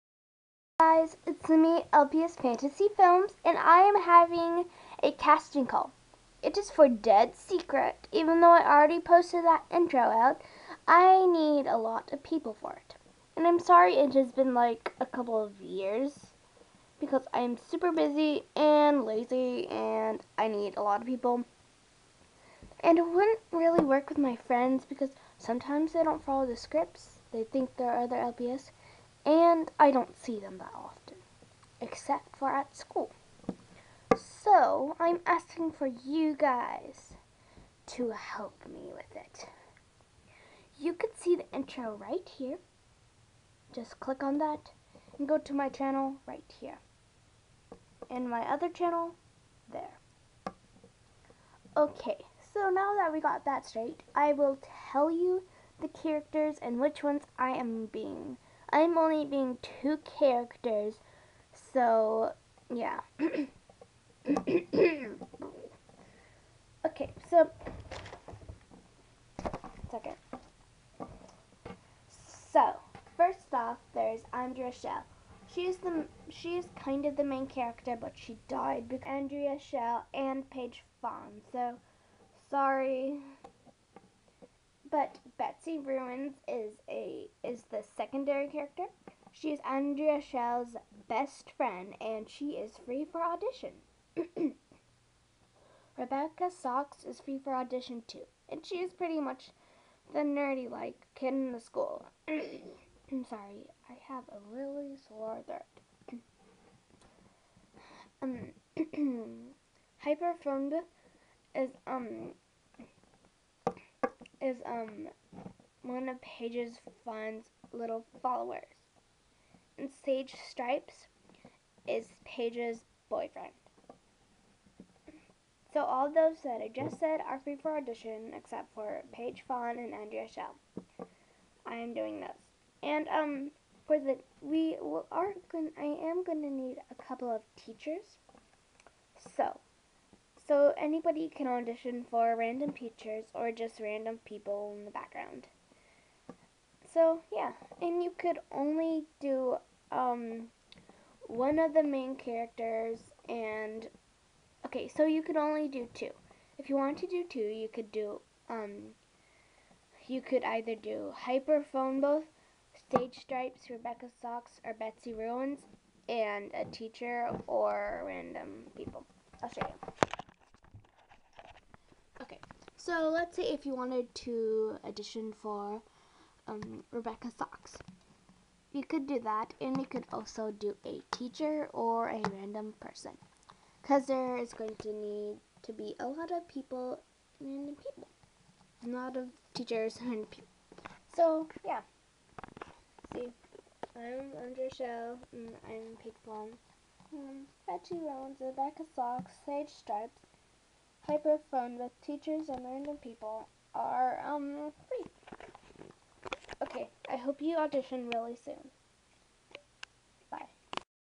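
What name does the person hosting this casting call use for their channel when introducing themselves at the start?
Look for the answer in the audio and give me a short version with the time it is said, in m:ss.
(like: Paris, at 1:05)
LPS Fantasy Films, at 0:01.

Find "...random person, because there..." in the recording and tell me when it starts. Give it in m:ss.
3:02.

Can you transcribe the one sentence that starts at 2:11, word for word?
I am doing this, And um for the we are going I am going to need a couple of teachers.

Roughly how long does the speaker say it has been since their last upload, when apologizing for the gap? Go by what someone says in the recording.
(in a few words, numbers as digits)
a couple of years.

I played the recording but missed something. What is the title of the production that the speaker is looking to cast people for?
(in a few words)
Dead Secret.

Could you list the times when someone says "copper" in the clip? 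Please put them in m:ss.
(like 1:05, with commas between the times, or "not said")
not said.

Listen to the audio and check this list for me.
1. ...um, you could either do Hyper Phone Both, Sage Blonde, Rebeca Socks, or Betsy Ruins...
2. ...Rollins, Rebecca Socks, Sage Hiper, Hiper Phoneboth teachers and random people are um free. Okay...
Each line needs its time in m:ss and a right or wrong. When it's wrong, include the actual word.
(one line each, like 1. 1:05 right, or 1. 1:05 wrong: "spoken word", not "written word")
1. 2:38 wrong: "Stripez", not "Blonde"
2. 3:18 wrong: "Stripez", not "Hiper".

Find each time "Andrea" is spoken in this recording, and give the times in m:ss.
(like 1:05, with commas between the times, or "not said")
1:14, 1:19, 1:29, 2:09, 3:14.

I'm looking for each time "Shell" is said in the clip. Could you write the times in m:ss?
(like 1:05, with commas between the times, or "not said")
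1:14, 1:19, 1:30, 2:10, 3:14.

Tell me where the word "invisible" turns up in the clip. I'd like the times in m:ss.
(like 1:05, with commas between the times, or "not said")
not said.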